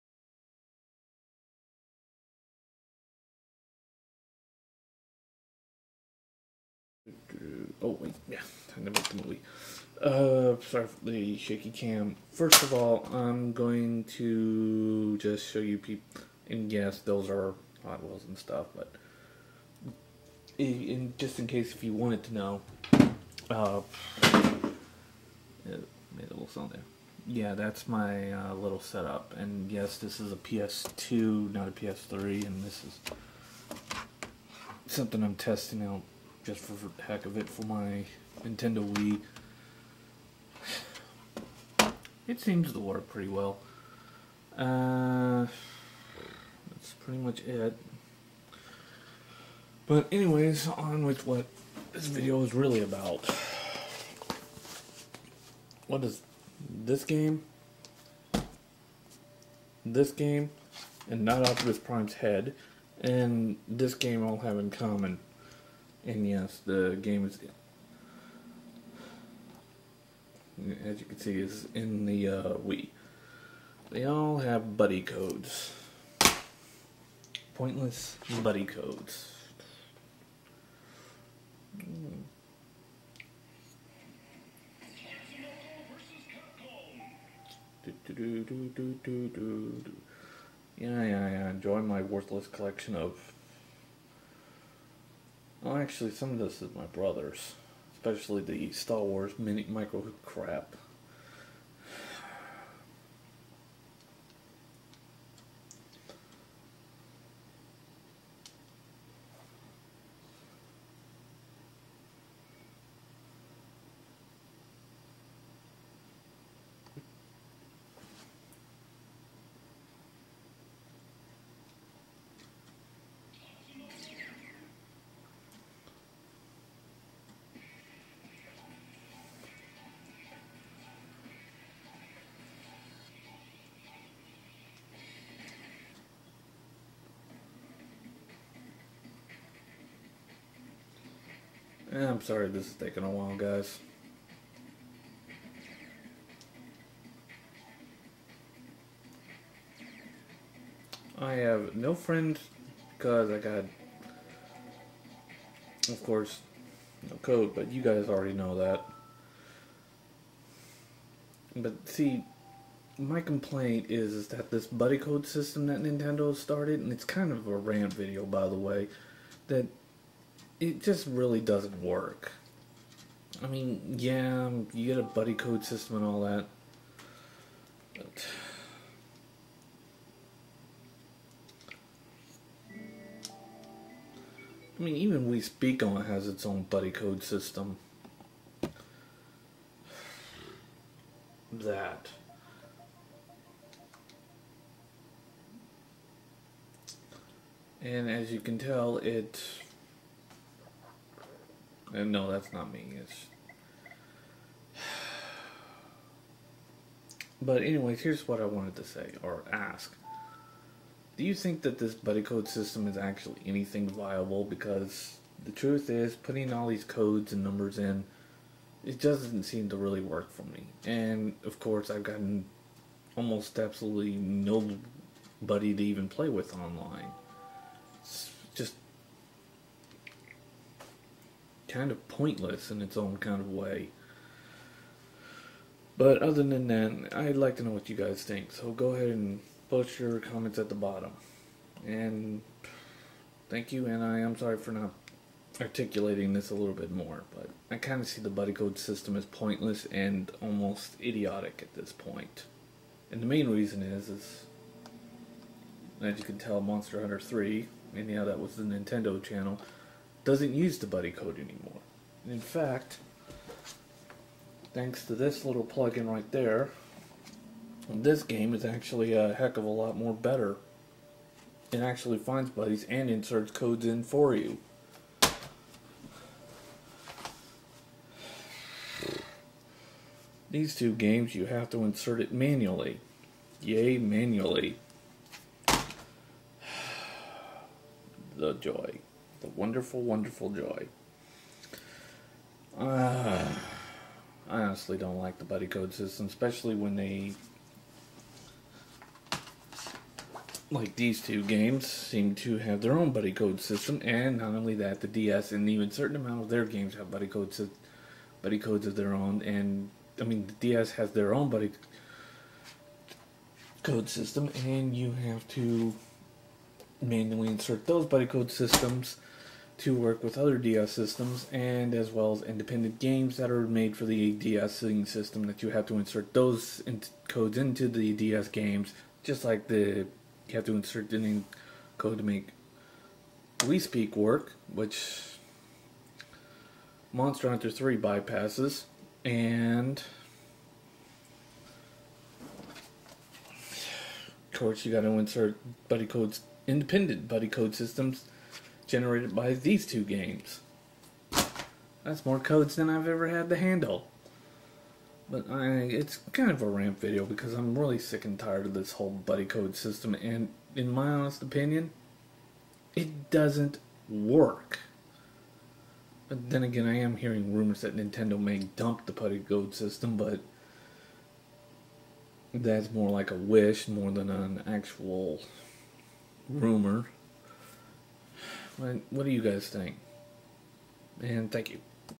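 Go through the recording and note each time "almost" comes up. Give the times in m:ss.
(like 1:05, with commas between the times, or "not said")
3:43, 4:10.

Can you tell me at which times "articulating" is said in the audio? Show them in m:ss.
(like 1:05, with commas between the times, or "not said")
4:05.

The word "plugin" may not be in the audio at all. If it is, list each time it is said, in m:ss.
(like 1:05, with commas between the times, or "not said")
4:25.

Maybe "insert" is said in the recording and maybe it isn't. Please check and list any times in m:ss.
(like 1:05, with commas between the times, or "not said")
4:33, 4:41, 5:17, 5:25, 5:30, 5:45.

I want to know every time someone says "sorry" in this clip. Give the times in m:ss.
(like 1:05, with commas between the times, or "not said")
0:10, 2:22, 4:04.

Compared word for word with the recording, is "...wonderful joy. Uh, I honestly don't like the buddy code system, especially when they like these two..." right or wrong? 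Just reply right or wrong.
right.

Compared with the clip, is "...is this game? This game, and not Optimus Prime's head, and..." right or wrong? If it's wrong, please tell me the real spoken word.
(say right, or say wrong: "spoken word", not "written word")
right.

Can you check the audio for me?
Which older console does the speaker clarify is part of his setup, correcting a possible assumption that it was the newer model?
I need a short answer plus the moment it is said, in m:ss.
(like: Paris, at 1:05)
PS2, at 0:30.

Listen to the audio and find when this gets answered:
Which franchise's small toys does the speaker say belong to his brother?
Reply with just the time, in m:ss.
1:38.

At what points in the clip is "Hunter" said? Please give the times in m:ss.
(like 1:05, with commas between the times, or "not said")
4:17, 5:37.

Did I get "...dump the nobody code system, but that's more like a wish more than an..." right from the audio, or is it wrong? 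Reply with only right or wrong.
wrong.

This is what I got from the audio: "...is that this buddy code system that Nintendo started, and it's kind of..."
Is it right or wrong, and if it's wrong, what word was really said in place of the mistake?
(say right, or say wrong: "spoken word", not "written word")
right.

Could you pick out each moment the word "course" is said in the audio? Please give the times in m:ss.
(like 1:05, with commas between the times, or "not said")
2:36, 3:41, 5:44.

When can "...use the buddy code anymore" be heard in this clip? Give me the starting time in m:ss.
4:20.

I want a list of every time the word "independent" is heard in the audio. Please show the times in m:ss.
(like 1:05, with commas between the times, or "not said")
5:22, 5:46.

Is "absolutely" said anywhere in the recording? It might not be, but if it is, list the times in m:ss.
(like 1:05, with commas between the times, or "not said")
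3:43.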